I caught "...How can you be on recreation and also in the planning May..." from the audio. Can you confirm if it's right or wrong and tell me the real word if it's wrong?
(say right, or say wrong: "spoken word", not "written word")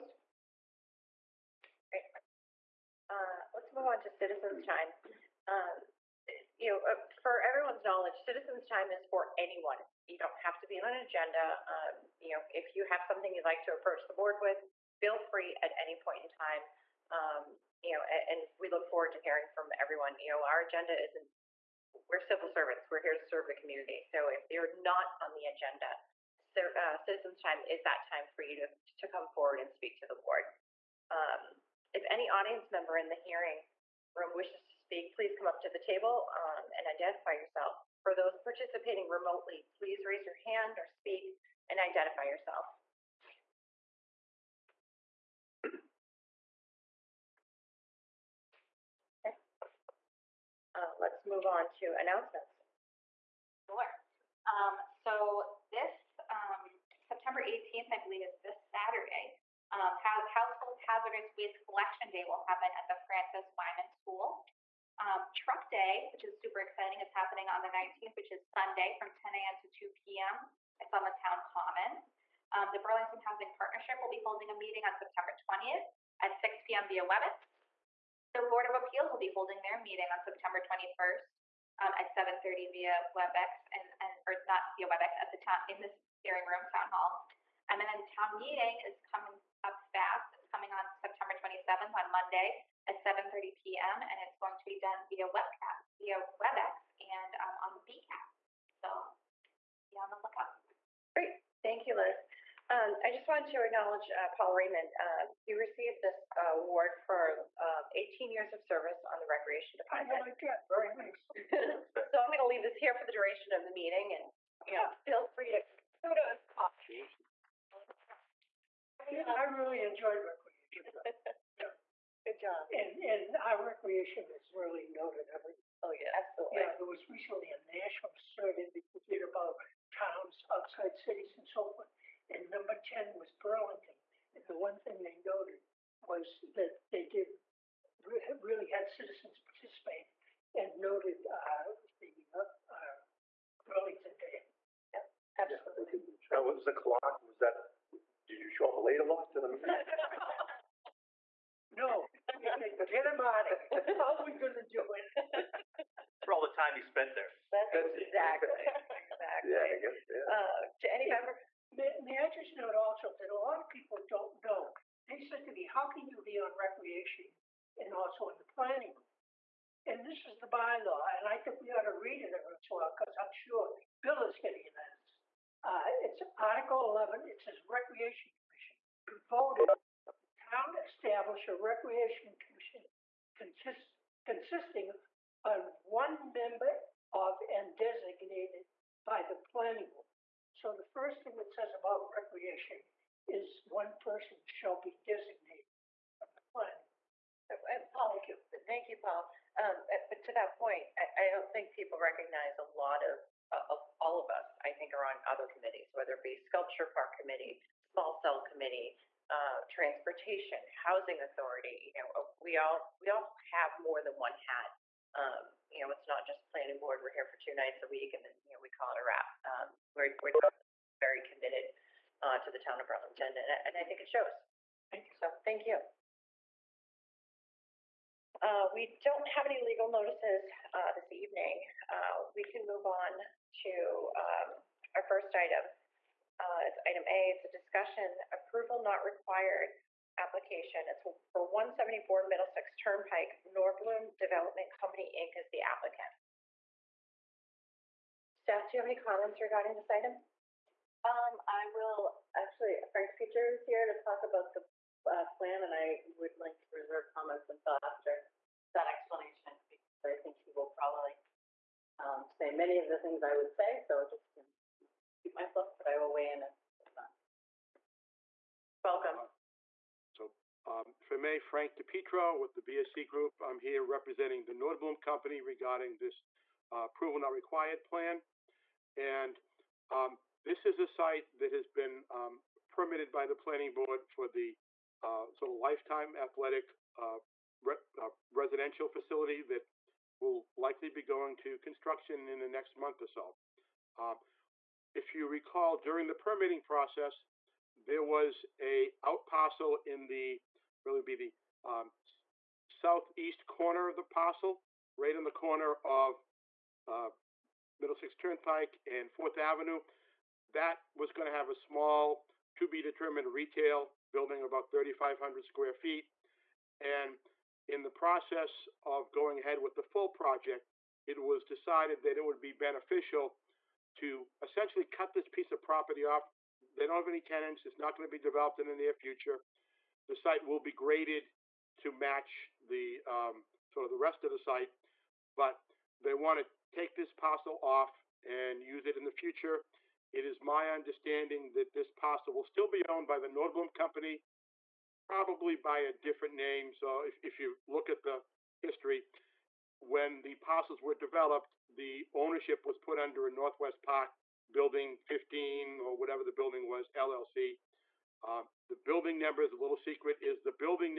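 wrong: "And", not "May".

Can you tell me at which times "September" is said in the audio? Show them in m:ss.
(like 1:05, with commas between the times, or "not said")
0:57, 1:14, 1:20, 1:30.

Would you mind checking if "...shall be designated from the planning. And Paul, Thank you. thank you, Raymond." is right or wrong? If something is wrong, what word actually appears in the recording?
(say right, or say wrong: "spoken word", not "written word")
wrong: "Paul", not "Raymond".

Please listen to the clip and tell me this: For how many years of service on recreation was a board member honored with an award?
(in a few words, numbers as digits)
18.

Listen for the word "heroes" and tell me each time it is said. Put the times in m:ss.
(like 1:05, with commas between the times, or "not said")
not said.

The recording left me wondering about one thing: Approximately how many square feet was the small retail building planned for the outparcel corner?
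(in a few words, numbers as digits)
3,500.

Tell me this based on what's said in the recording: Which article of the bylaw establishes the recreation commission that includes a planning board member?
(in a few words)
Article 11.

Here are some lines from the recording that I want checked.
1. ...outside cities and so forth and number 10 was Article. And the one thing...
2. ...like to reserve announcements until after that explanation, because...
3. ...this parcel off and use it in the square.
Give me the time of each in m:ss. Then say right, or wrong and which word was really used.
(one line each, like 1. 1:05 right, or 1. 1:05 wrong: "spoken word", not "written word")
1. 2:10 wrong: "Burlington", not "Article"
2. 4:16 wrong: "comments", not "announcements"
3. 5:36 wrong: "future", not "square".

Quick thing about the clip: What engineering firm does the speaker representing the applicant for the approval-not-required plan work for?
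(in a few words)
BSC Group.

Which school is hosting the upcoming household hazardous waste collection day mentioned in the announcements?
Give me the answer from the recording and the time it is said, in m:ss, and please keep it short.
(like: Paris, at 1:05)
Francis Wyman School, at 1:03.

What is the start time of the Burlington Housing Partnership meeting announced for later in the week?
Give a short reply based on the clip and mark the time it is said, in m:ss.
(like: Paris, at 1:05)
6 p.m., at 1:16.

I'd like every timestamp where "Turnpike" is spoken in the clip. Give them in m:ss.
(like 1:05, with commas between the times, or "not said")
4:02, 5:08.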